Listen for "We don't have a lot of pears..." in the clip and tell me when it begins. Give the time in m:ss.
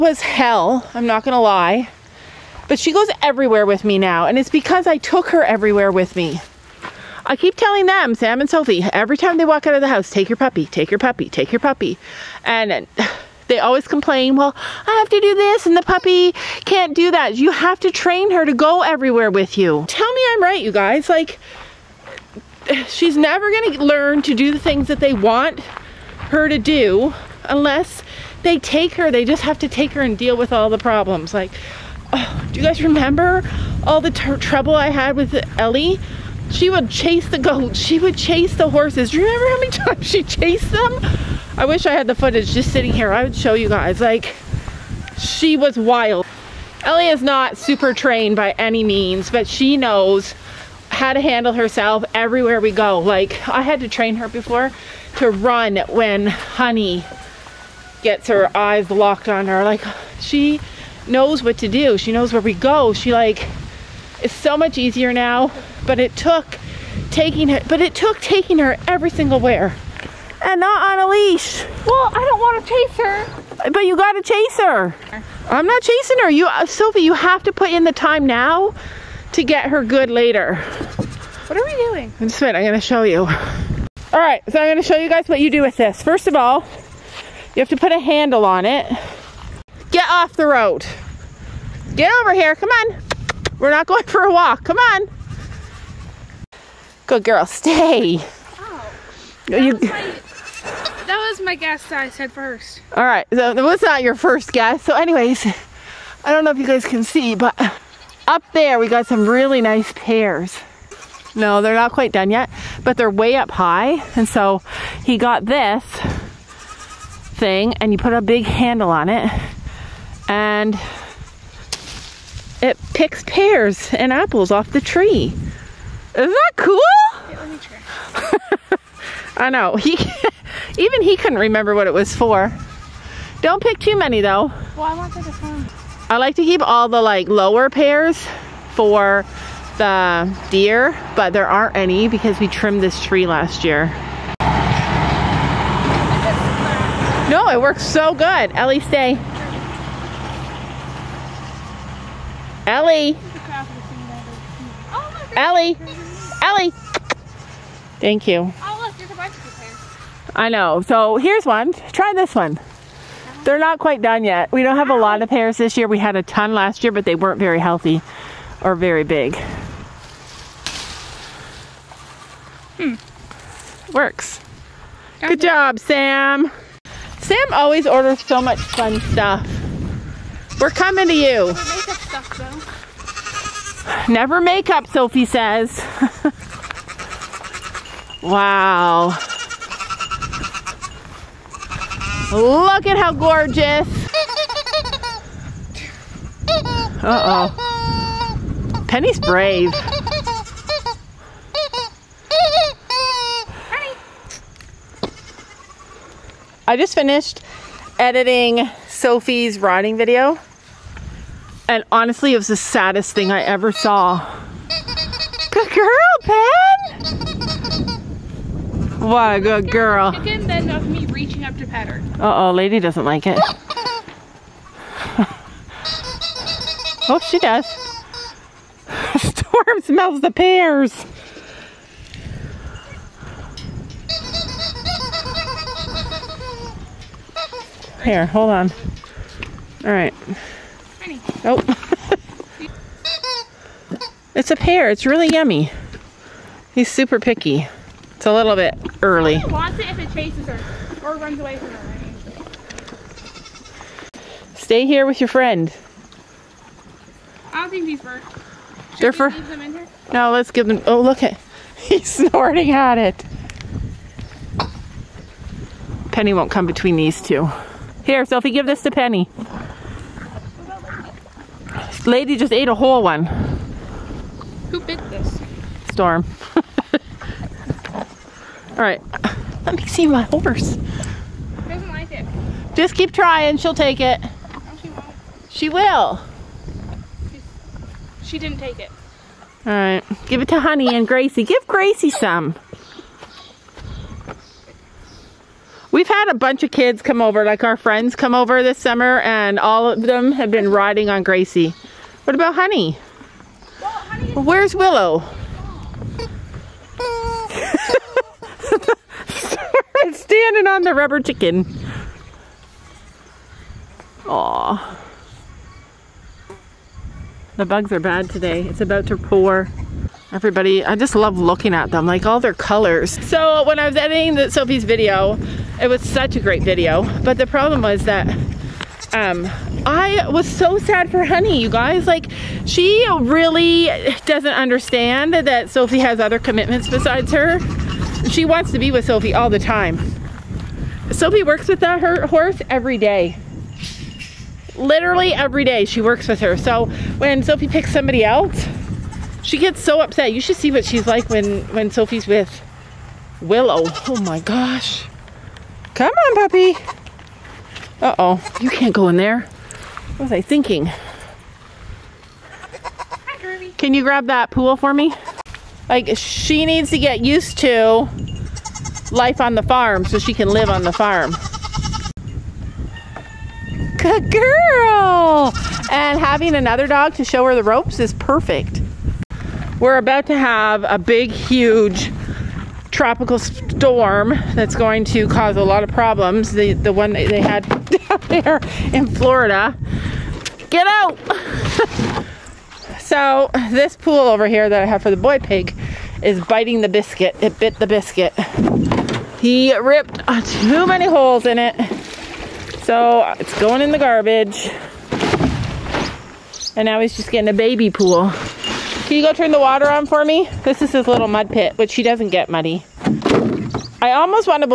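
2:44.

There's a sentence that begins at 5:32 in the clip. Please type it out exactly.
Like, she really doesn't understand that Sophie has other commitments besides her.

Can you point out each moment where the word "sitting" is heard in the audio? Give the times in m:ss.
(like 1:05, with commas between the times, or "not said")
0:42.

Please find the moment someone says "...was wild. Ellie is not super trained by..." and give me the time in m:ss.
0:45.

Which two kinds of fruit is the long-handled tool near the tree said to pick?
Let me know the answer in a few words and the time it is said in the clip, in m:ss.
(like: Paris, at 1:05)
pears and apples, at 2:03.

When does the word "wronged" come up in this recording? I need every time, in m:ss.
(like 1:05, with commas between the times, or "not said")
not said.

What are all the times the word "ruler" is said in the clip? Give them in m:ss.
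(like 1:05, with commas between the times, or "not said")
not said.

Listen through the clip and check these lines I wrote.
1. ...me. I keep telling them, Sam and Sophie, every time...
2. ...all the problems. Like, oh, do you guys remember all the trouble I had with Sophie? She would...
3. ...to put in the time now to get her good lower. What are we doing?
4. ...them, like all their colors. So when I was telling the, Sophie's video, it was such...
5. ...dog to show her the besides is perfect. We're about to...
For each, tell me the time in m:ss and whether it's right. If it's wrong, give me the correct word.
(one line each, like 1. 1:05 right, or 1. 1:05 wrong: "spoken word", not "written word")
1. 0:06 right
2. 0:30 wrong: "Ellie", not "Sophie"
3. 1:17 wrong: "later", not "lower"
4. 5:21 wrong: "editing", not "telling"
5. 6:16 wrong: "ropes", not "besides".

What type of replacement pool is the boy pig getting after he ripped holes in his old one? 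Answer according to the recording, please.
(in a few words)
a baby pool.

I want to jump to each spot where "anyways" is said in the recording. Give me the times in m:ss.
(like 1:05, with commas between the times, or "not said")
1:44.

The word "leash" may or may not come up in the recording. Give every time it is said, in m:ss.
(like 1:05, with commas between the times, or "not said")
1:11.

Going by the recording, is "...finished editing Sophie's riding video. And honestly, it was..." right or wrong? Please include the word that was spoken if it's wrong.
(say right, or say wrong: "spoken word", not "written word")
right.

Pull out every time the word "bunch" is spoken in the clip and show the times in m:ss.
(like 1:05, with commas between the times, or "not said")
2:39, 4:56.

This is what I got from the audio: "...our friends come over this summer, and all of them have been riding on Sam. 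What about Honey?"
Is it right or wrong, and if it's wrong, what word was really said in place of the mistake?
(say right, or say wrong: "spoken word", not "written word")
wrong: "Gracie", not "Sam".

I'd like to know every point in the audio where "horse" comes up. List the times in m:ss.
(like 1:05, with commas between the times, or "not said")
0:38, 4:40, 5:42.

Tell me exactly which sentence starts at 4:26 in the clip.
Penny won't come between these two.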